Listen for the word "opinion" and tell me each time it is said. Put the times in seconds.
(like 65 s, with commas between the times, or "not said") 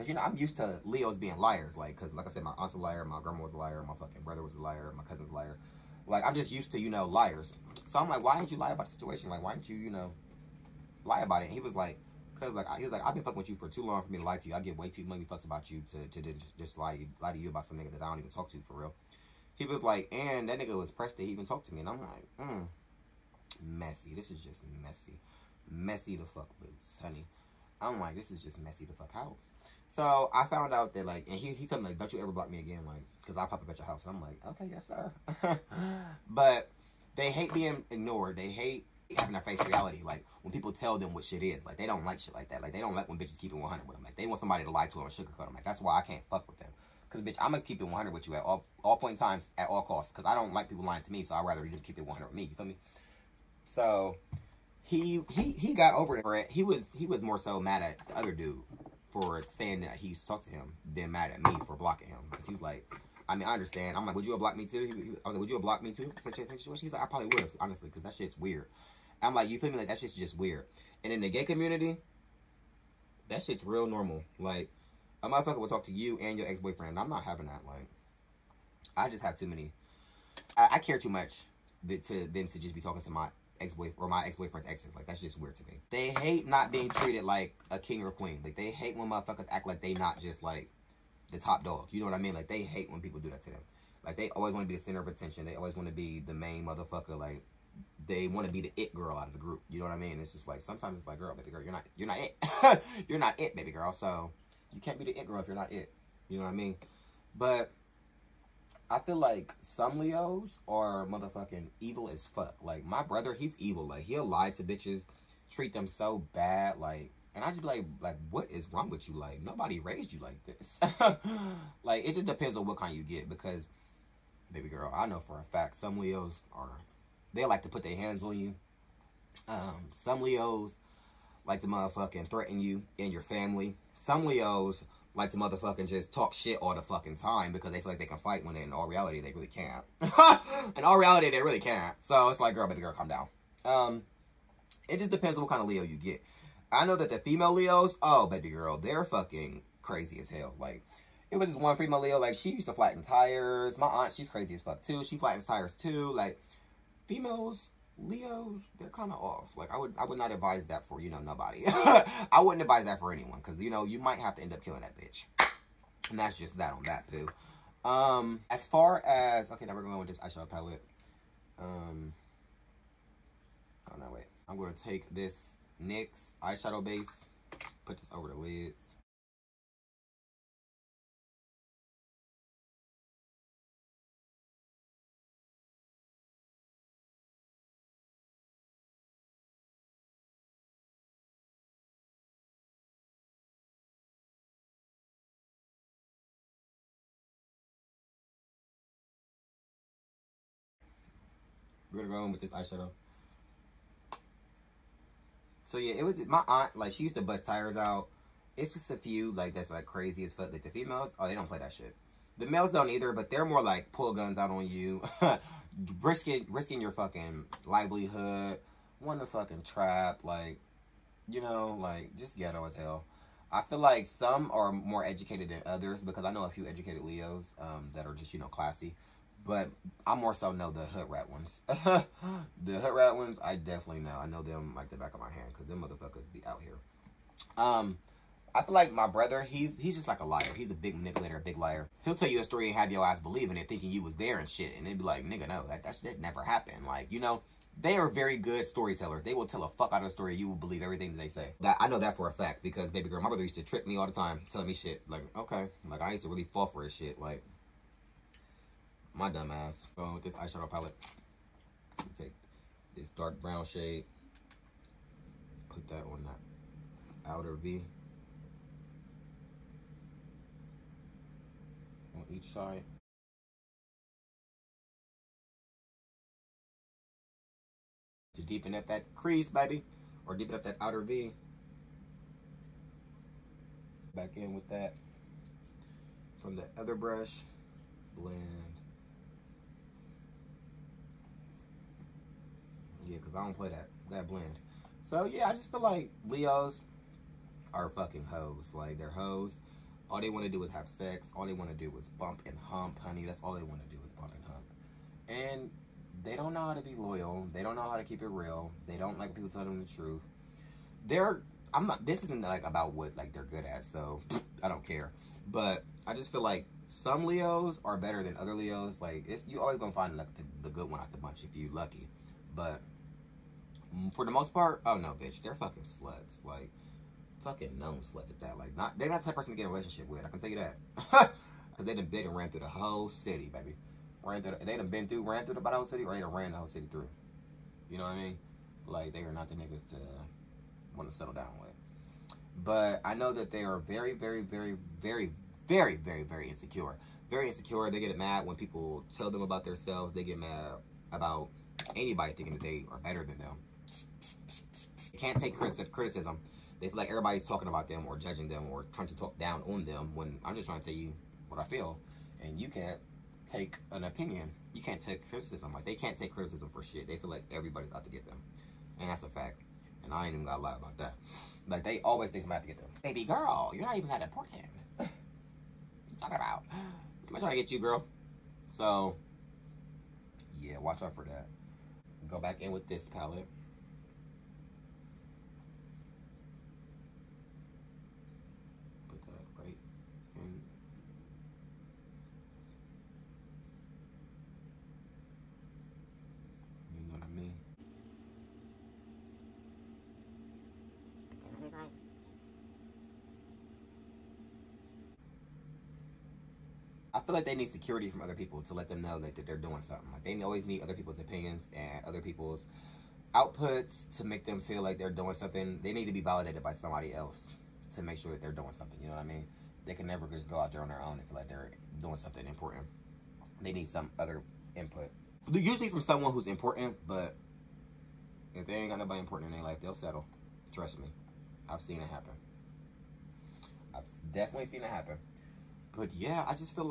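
364 s, 411 s.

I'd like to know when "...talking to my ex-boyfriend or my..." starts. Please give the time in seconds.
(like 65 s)
82 s.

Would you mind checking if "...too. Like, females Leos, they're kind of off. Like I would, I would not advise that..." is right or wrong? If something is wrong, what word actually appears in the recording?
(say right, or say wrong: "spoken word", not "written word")
right.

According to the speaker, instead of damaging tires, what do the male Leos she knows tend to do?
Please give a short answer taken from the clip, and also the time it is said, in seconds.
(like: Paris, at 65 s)
Pull guns out, at 213 s.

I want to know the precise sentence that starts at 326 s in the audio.
Like, fucking known sluts at that.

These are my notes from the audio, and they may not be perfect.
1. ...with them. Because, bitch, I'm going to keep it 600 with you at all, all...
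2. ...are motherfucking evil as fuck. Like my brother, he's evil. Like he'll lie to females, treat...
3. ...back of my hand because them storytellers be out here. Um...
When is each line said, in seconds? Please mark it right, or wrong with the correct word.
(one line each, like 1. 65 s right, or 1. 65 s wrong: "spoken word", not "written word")
1. 46 s wrong: "100", not "600"
2. 110 s wrong: "bitches", not "females"
3. 234 s wrong: "motherfuckers", not "storytellers".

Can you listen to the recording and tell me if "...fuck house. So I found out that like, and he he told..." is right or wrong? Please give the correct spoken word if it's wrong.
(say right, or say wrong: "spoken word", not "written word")
right.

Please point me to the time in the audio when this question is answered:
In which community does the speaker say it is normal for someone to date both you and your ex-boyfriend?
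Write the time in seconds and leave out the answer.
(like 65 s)
71 s.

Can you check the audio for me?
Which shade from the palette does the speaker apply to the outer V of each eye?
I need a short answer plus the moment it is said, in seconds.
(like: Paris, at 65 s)
Dark brown, at 263 s.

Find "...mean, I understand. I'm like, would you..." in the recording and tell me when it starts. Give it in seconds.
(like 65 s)
63 s.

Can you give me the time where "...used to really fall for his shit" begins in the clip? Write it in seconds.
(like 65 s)
256 s.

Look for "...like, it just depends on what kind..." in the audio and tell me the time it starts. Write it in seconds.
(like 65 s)
121 s.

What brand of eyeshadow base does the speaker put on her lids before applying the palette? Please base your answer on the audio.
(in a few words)
NYX.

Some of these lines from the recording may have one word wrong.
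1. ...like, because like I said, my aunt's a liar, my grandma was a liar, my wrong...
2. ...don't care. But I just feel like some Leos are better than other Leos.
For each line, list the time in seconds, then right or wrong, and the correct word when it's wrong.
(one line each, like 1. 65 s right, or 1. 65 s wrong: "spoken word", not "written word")
1. 1 s wrong: "fucking", not "wrong"
2. 314 s right.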